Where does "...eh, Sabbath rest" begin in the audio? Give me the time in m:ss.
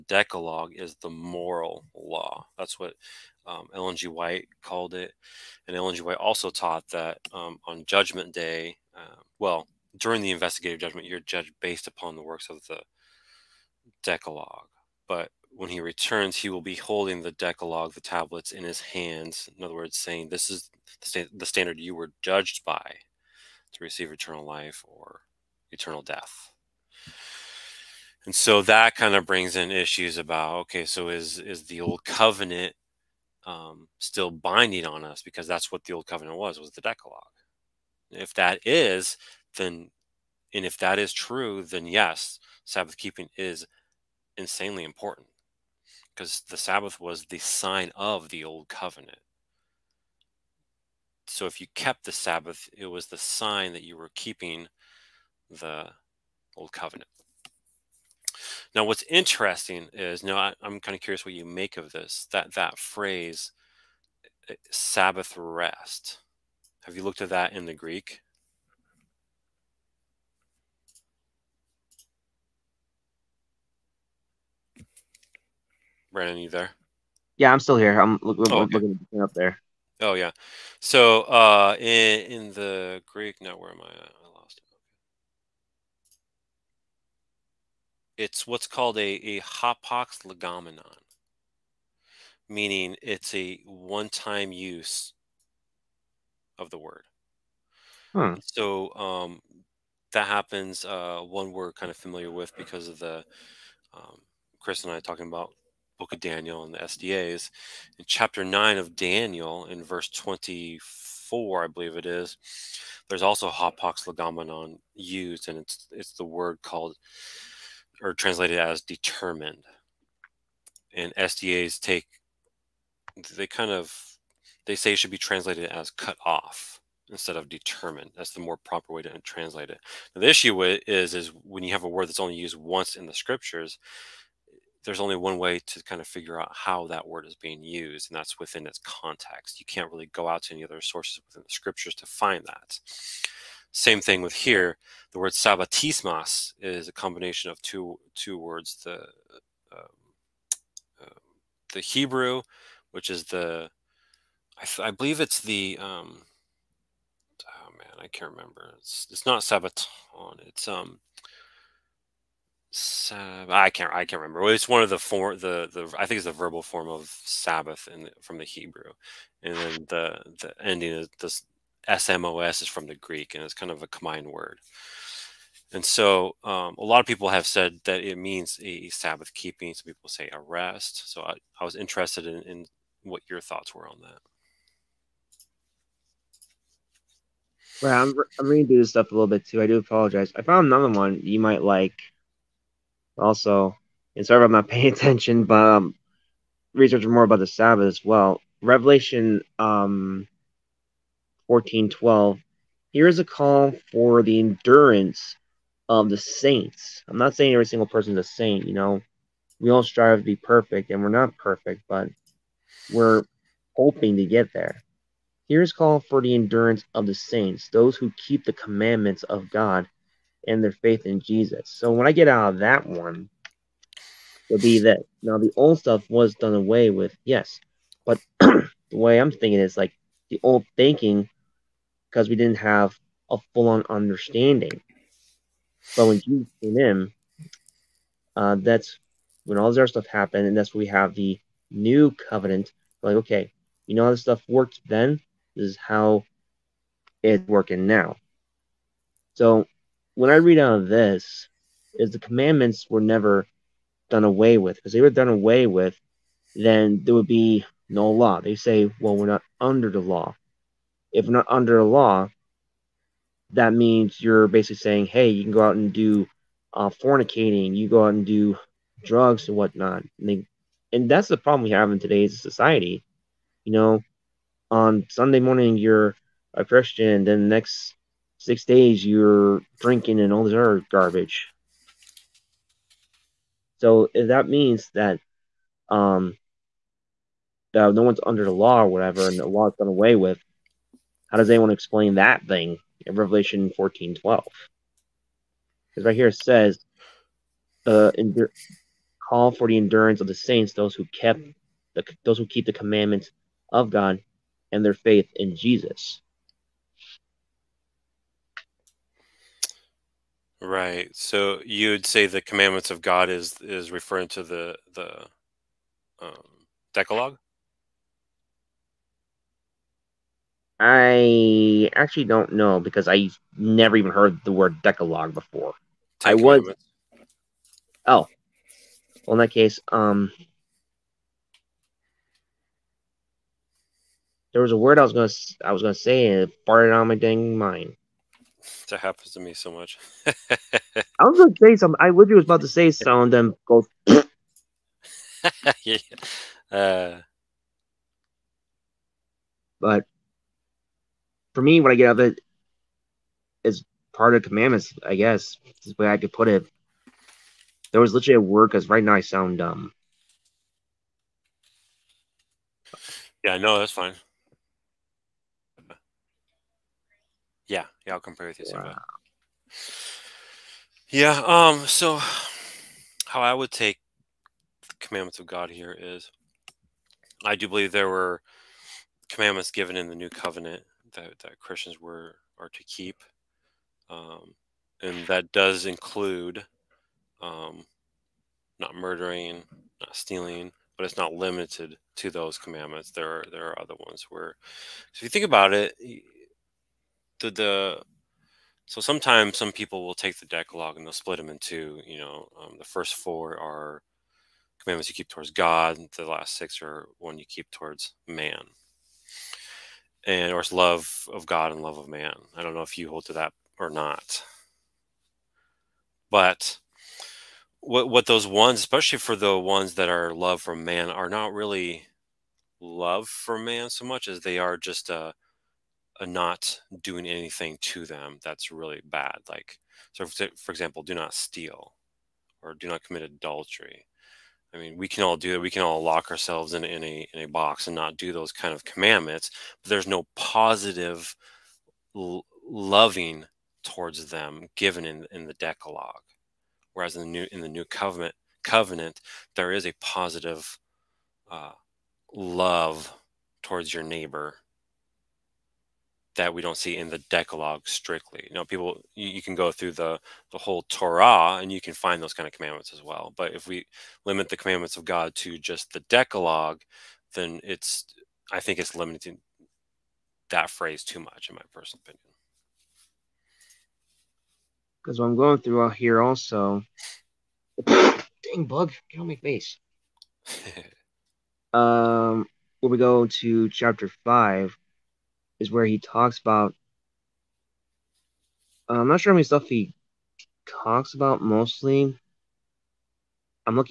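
1:04.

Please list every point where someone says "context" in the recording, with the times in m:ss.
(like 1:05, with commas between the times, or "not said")
2:18.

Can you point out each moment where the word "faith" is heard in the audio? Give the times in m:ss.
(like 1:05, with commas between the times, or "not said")
3:40, 5:04.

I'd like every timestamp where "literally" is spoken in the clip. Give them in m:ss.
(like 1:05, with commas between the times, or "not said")
5:42, 5:58.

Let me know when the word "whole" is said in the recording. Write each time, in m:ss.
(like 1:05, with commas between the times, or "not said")
7:40.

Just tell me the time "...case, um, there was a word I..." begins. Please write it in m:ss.
5:29.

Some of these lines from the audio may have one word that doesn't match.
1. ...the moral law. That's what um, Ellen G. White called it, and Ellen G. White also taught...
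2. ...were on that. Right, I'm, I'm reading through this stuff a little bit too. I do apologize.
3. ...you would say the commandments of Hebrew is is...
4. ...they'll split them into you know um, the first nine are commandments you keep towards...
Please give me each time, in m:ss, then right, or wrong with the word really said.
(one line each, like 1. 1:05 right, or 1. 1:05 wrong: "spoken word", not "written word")
1. 0:00 right
2. 3:03 right
3. 5:11 wrong: "God", not "Hebrew"
4. 6:41 wrong: "four", not "nine".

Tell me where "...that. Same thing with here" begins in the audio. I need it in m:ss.
2:22.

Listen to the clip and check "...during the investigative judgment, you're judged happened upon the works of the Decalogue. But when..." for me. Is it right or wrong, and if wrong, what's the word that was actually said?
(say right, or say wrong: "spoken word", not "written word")
wrong: "based", not "happened".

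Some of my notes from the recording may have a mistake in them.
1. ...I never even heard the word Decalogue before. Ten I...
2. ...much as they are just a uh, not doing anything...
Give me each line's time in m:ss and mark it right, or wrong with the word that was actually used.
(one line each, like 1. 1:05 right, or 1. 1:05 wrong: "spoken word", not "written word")
1. 5:23 right
2. 7:04 right.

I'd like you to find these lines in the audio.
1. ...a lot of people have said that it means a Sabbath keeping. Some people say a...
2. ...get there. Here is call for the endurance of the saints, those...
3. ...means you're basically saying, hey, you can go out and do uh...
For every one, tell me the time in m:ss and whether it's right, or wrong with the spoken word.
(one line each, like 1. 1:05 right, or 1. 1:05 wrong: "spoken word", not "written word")
1. 2:56 right
2. 3:34 right
3. 4:23 right.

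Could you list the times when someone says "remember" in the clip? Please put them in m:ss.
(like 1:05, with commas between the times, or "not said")
2:38, 2:44.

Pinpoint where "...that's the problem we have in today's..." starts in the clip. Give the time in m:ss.
4:31.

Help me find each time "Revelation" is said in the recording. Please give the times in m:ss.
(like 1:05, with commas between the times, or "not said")
3:18, 4:53.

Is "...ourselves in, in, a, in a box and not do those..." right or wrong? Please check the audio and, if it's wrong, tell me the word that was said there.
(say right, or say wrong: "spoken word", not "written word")
right.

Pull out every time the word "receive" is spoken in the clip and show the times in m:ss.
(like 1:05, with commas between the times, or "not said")
0:23.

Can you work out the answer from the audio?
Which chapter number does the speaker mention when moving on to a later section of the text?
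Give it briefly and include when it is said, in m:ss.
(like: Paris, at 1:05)
5, at 8:03.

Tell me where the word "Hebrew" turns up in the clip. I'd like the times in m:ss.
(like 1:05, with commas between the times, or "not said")
2:31, 2:48.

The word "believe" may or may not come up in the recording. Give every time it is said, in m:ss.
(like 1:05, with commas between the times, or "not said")
1:51, 2:34, 6:17.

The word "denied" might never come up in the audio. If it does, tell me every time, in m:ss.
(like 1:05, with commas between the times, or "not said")
not said.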